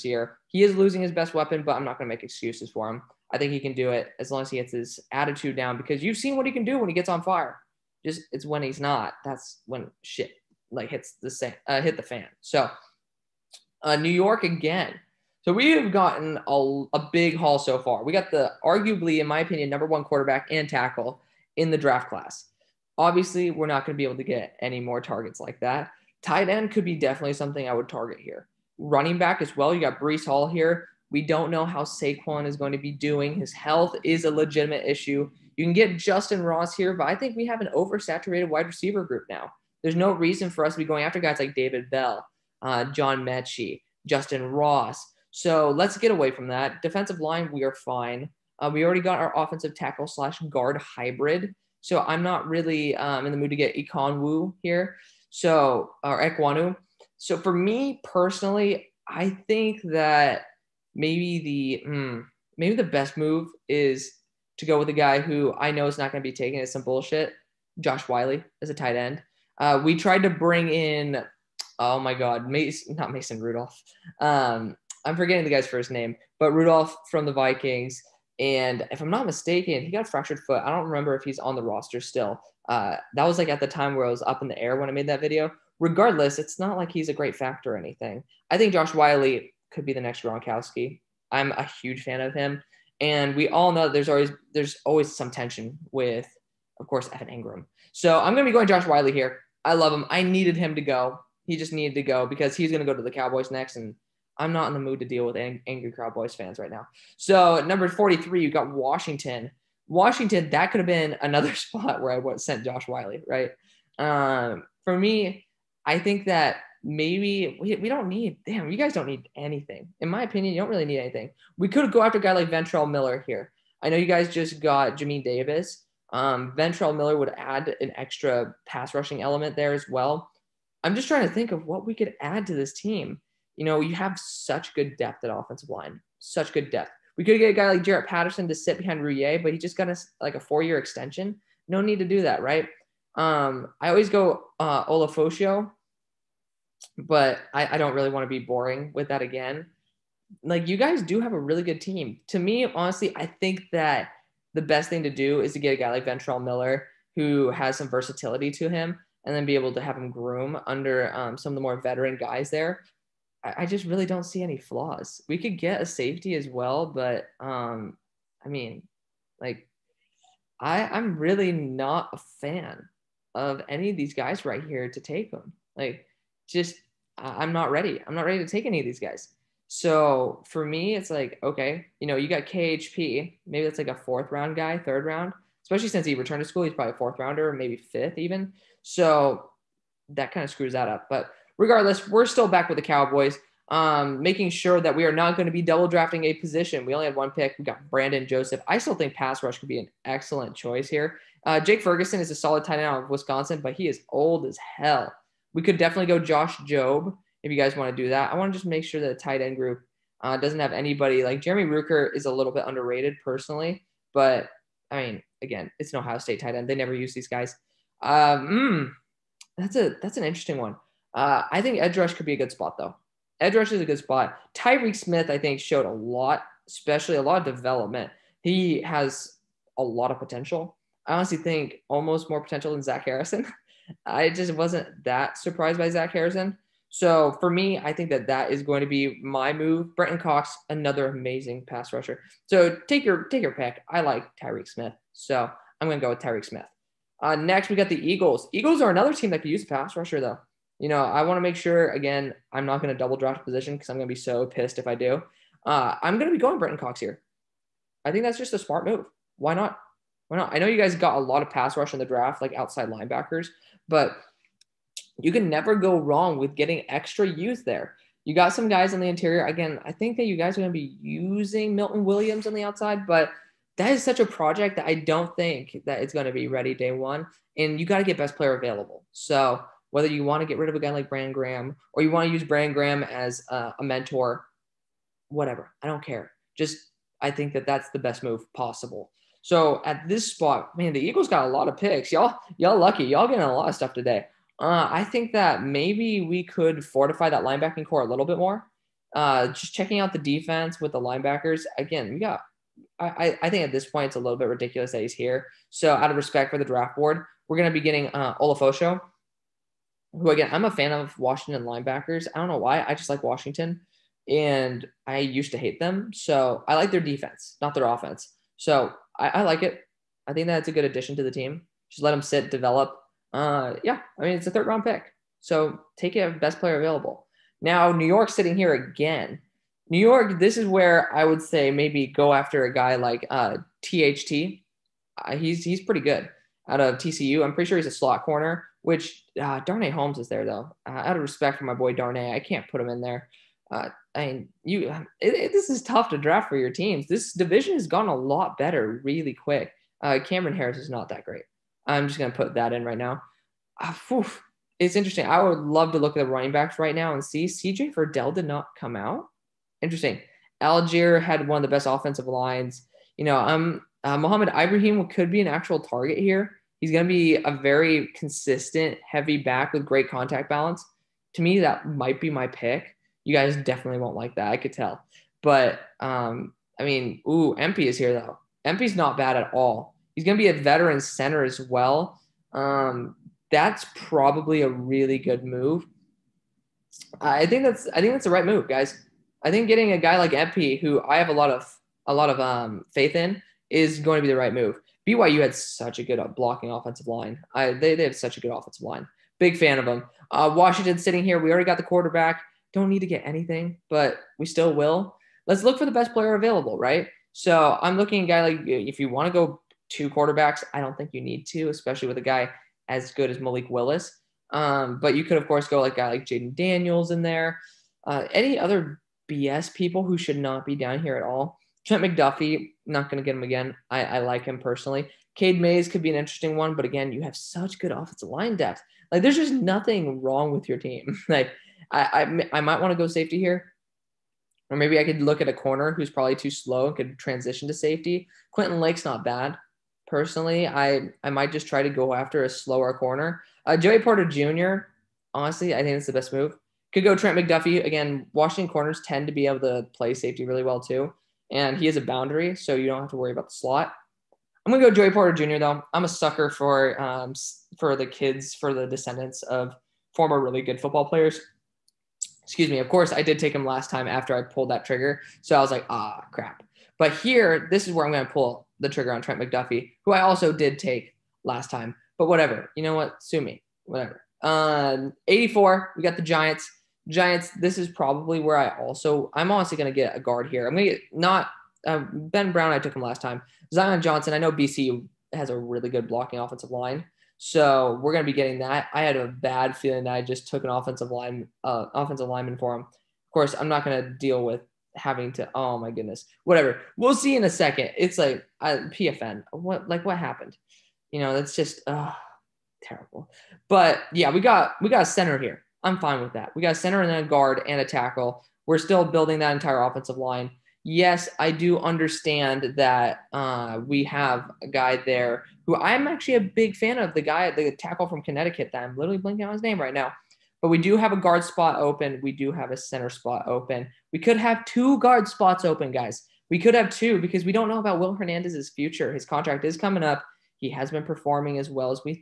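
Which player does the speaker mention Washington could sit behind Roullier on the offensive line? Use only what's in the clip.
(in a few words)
Jarrett Patterson.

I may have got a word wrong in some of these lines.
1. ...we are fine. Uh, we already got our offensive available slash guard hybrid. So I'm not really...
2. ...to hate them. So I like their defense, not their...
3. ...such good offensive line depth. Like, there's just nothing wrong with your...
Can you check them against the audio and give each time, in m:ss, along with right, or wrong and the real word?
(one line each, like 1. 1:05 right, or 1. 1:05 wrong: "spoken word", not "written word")
1. 0:47 wrong: "tackle", not "available"
2. 5:15 right
3. 7:07 right.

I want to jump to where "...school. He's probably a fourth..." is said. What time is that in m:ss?
3:06.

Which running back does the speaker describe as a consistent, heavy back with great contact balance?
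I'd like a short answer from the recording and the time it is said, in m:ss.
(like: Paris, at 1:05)
Muhammad Ibrahim, at 6:04.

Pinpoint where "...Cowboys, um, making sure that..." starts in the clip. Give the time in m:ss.
3:12.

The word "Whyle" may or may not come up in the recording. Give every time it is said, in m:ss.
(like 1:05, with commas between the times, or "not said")
1:08, 1:28, 1:38, 1:52.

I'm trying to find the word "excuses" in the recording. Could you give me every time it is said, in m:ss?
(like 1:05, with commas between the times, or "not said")
0:02, 7:42.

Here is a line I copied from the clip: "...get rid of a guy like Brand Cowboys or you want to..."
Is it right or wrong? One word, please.
wrong.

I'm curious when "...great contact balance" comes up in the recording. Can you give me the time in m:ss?
6:09.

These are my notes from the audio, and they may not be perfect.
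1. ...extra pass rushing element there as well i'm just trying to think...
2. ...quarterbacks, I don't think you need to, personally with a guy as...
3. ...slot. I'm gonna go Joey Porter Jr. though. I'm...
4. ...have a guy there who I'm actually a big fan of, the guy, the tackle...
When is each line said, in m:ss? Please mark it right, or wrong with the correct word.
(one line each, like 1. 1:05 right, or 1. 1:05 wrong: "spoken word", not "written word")
1. 2:07 right
2. 6:50 wrong: "especially", not "personally"
3. 7:33 right
4. 8:34 right.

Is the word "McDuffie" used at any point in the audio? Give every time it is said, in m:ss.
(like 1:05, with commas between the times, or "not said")
7:02, 7:27, 7:49.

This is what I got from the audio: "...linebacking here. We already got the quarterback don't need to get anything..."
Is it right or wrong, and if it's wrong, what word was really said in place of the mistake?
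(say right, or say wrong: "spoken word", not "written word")
wrong: "sitting", not "linebacking".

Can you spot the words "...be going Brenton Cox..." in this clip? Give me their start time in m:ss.
4:16.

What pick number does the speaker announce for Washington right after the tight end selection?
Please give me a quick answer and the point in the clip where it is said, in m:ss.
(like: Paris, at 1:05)
43, at 1:47.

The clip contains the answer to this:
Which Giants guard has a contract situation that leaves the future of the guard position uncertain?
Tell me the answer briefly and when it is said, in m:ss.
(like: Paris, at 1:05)
Will Hernandez, at 8:47.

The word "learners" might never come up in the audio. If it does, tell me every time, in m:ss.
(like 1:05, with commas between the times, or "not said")
not said.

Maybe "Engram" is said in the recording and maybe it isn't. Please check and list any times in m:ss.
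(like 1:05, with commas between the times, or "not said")
1:37.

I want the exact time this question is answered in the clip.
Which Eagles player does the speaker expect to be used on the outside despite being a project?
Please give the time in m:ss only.
4:31.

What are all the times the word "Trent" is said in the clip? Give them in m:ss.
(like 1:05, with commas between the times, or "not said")
7:01, 7:27, 7:49.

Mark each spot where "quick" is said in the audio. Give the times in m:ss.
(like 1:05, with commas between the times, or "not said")
5:49.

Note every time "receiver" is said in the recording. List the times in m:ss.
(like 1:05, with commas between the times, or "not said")
0:38.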